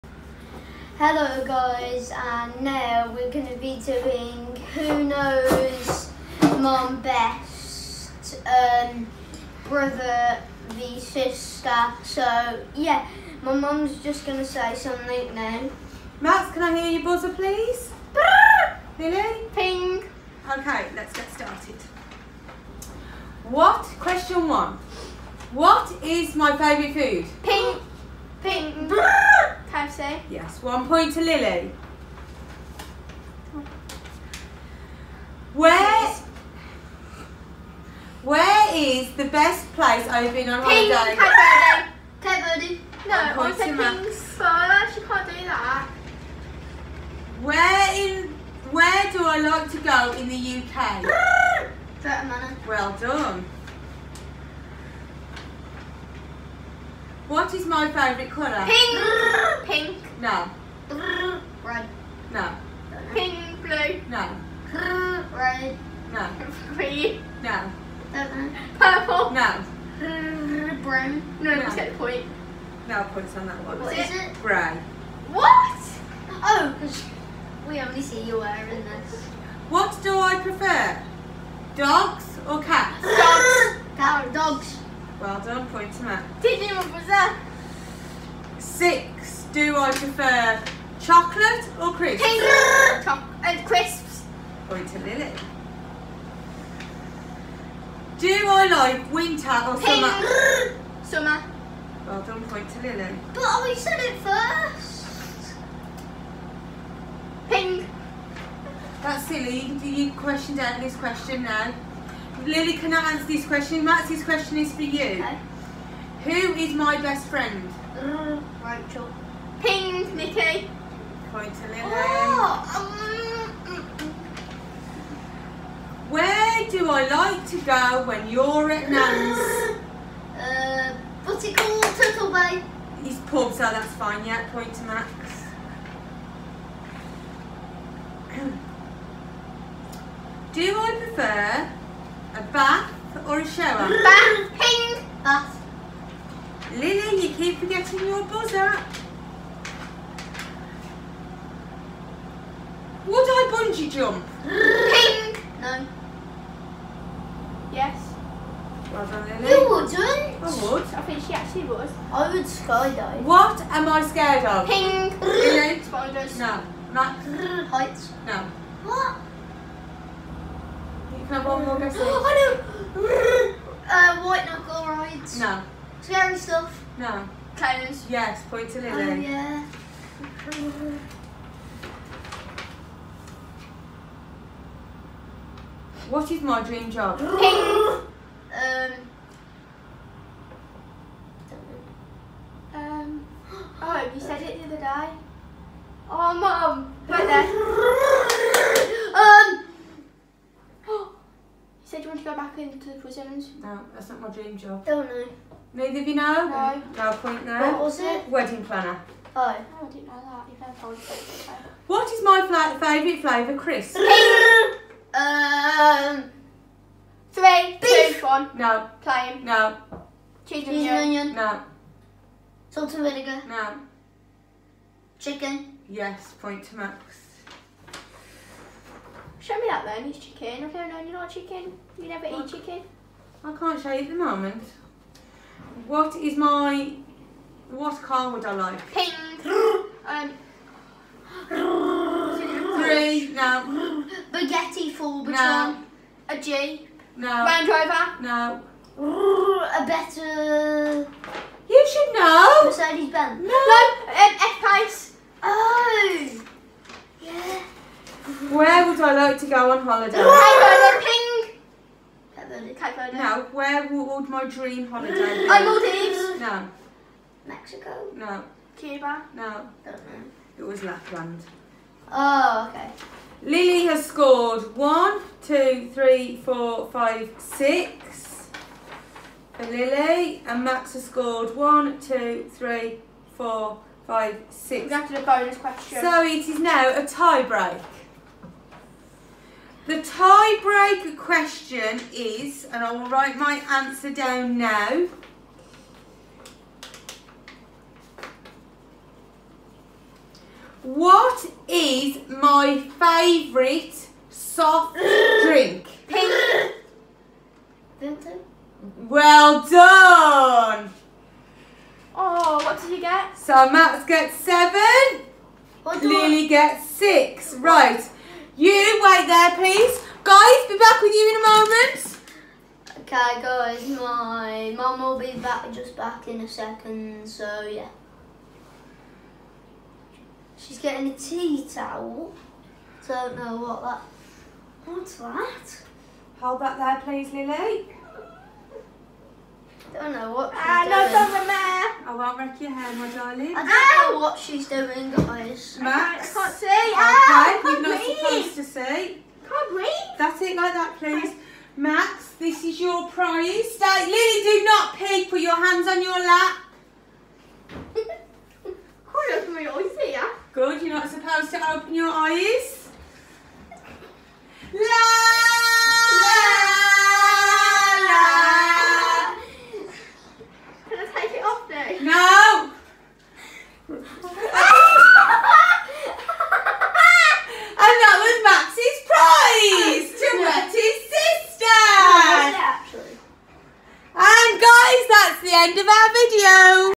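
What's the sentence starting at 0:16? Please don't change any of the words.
Max, can I hear your buzzer please?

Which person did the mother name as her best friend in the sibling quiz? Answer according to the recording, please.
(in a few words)
Nikki.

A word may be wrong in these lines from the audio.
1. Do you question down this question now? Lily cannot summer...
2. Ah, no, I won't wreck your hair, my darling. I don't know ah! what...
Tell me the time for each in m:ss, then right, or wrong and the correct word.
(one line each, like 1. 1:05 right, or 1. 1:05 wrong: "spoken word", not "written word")
1. 1:49 wrong: "answer", not "summer"
2. 5:40 right.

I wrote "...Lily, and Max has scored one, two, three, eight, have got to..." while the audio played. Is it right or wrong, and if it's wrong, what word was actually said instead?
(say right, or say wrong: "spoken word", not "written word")
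wrong: "four", not "eight".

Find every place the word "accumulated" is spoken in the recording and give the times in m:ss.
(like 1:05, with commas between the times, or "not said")
not said.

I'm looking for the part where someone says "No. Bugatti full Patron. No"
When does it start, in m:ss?
4:03.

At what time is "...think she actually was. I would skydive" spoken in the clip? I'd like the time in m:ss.
2:41.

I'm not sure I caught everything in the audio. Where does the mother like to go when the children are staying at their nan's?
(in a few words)
Turtle Bay.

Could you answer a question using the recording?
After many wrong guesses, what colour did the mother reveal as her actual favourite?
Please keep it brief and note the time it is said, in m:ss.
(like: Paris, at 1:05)
Grey, at 1:14.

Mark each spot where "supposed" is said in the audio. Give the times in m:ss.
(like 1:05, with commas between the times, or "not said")
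5:48, 6:01.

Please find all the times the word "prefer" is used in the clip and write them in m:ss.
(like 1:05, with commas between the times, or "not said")
1:20, 1:29, 2:21.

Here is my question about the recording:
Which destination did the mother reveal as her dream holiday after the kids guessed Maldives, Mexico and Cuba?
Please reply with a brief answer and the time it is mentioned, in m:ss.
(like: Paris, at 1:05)
Lapland, at 4:30.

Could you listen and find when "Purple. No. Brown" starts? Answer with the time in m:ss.
1:08.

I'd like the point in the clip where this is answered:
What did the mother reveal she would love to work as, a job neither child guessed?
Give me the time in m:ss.
3:28.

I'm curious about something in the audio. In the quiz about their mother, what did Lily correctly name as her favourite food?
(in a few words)
Toasty.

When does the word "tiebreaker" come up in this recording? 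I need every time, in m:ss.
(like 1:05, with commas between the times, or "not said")
4:49.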